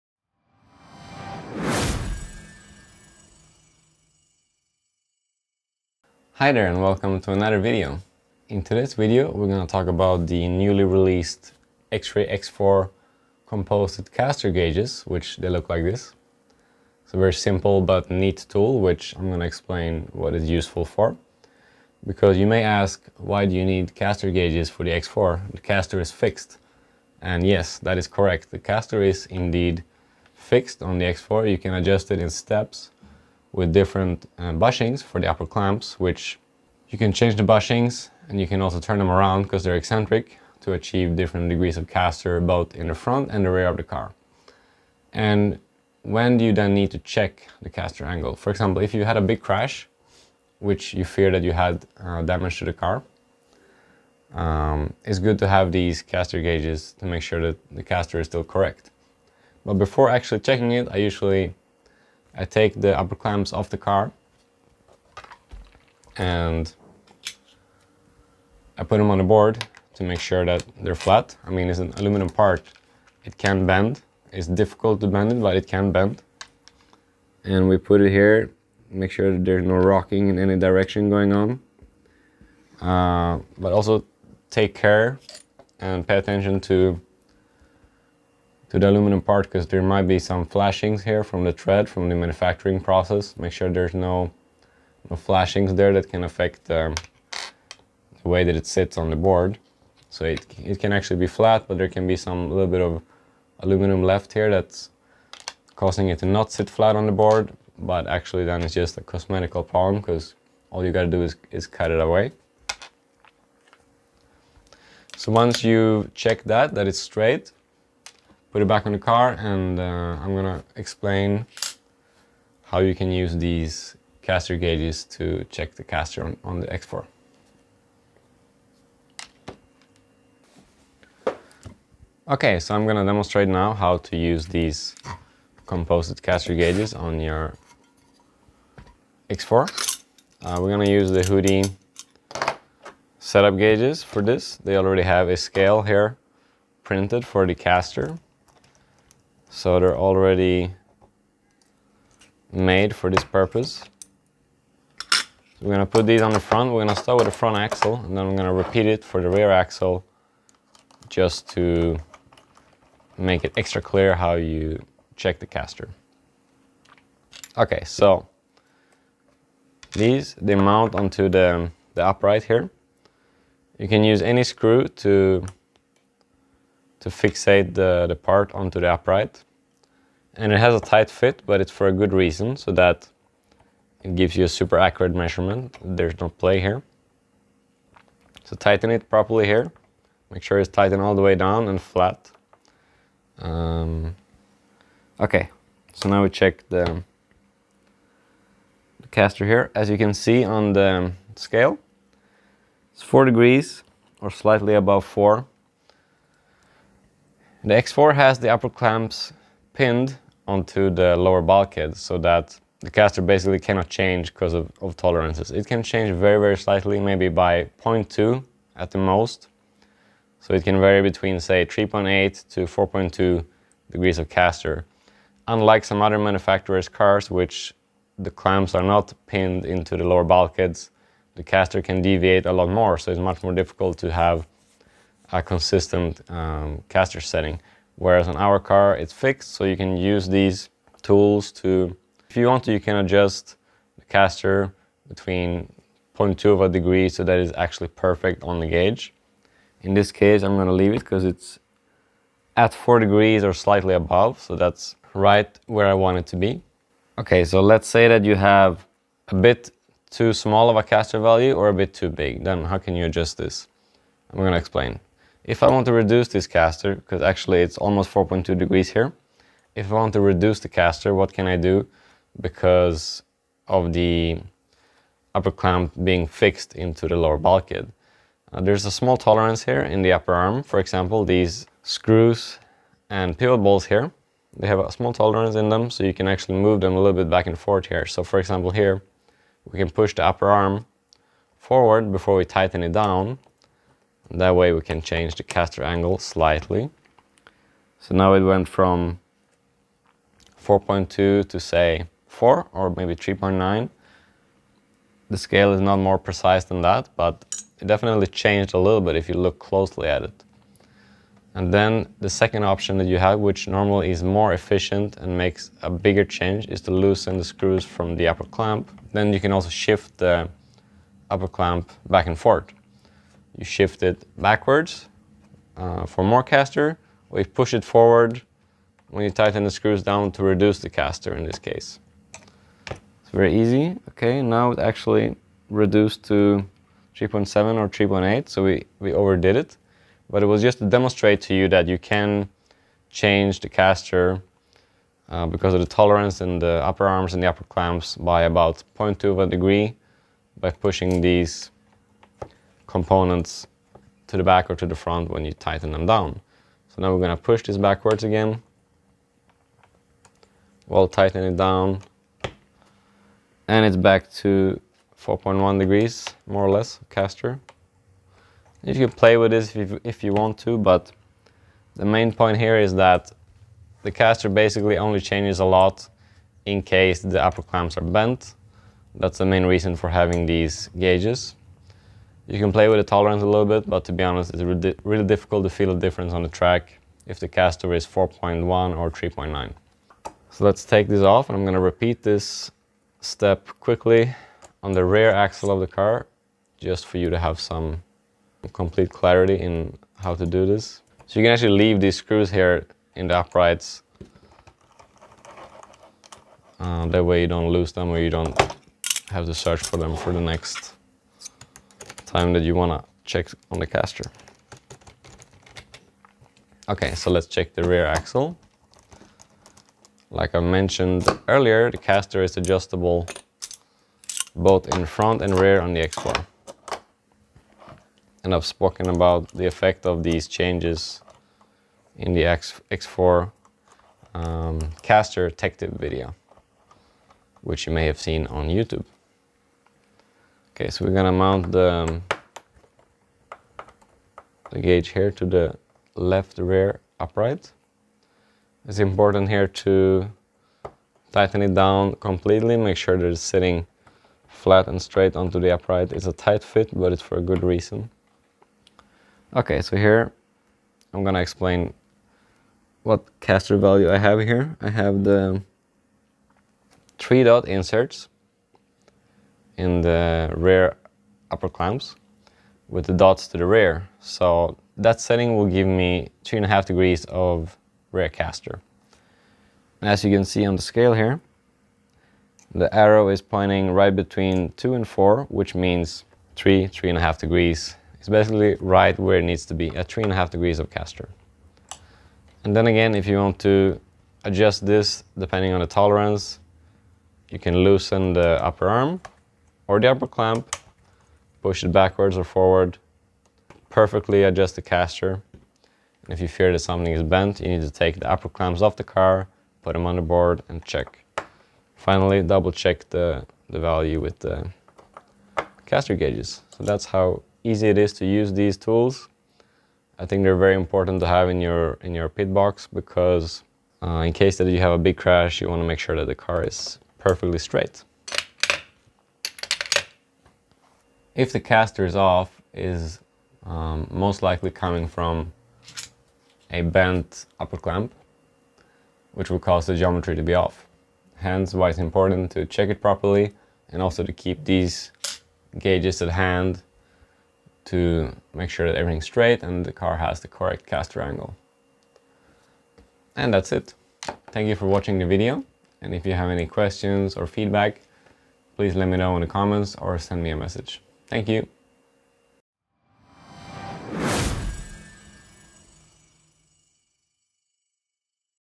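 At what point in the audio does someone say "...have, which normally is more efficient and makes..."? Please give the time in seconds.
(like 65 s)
313 s.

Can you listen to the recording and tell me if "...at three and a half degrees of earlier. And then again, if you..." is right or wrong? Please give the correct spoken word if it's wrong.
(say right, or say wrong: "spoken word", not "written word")
wrong: "caster", not "earlier".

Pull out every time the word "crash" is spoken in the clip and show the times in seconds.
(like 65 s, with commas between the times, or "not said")
49 s, 525 s.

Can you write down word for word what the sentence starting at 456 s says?
It's a tight fit, but it's for a good reason.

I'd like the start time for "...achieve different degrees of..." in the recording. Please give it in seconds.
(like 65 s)
40 s.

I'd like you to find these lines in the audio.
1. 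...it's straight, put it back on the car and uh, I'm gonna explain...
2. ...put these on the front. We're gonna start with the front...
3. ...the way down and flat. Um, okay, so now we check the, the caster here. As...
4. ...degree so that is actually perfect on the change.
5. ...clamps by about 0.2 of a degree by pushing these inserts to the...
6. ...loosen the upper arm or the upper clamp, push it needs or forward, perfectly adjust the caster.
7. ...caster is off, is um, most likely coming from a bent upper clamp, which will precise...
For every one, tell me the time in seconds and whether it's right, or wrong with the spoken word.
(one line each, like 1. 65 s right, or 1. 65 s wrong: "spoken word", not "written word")
1. 116 s right
2. 155 s right
3. 191 s right
4. 246 s wrong: "gauge", not "change"
5. 347 s wrong: "components", not "inserts"
6. 497 s wrong: "backwards", not "needs"
7. 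531 s wrong: "cause", not "precise".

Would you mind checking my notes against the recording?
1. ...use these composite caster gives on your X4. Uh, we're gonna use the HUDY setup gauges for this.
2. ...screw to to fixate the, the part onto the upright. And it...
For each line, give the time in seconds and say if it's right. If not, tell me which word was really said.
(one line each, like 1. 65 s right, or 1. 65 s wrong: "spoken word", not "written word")
1. 134 s wrong: "gauges", not "gives"
2. 174 s right.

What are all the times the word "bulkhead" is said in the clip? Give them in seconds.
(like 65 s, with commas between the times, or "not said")
211 s, 230 s, 277 s.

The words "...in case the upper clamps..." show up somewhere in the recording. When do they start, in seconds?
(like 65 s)
376 s.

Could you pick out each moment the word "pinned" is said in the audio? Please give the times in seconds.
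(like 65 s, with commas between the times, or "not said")
209 s, 229 s.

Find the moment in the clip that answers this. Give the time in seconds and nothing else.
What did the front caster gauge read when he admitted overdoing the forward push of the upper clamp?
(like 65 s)
337 s.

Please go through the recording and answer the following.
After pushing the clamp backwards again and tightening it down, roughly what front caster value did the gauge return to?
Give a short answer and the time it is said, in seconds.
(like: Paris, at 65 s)
4.1 degrees, at 365 s.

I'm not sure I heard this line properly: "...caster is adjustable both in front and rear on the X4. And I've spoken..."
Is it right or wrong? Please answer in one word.
right.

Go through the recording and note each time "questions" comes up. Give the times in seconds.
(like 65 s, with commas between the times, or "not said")
556 s.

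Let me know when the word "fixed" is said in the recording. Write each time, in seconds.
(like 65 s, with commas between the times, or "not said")
26 s, 30 s, 239 s, 276 s.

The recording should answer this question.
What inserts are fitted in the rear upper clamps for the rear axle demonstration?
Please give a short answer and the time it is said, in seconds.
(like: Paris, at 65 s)
three dot inserts, at 467 s.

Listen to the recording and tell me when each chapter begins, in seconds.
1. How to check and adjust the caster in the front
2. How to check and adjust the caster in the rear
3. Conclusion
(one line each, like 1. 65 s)
1. 130 s
2. 440 s
3. 530 s.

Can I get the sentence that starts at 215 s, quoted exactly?
It can change very, very slightly, maybe by 0.2 at the most.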